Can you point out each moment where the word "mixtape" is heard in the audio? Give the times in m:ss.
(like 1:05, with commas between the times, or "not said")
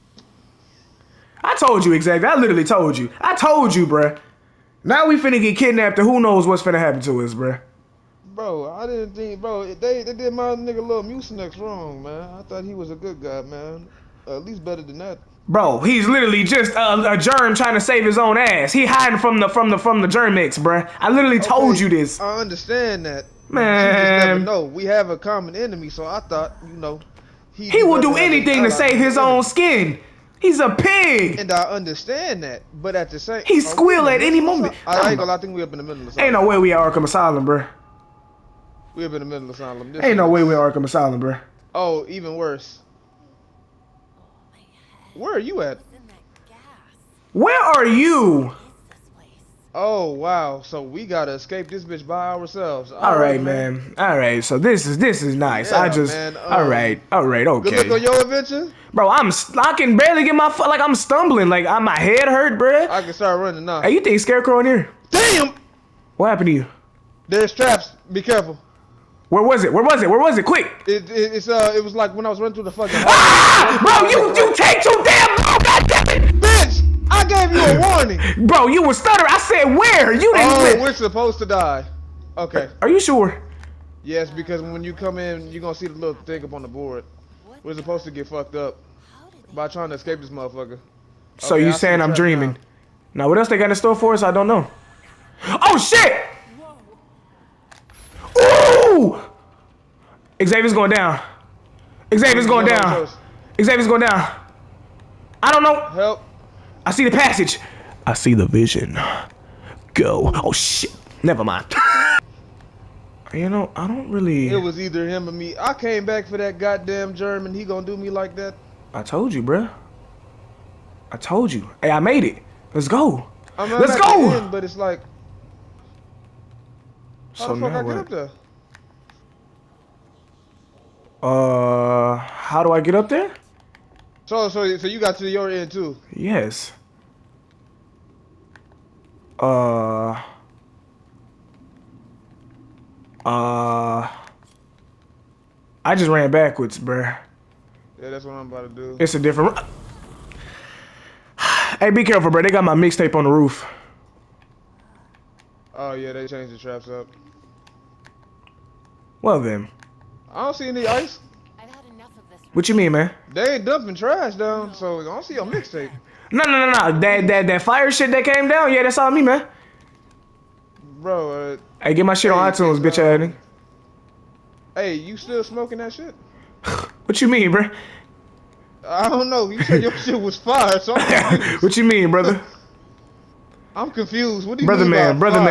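2:32, 2:45.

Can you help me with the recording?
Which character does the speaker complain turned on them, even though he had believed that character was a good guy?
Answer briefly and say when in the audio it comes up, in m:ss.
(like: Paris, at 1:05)
Mucinex, at 0:11.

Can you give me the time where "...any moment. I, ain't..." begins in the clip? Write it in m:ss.
0:34.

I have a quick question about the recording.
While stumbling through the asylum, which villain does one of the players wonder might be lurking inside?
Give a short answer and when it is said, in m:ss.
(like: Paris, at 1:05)
Scarecrow, at 1:04.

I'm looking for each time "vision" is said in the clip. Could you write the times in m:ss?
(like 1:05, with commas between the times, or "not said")
1:48.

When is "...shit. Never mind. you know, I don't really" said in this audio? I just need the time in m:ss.
1:50.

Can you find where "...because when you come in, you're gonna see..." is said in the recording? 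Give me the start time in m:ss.
1:24.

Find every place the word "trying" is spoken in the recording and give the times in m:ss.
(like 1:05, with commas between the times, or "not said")
0:17, 1:29.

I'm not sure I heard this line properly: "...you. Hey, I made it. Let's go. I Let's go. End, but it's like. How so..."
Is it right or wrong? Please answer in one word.
right.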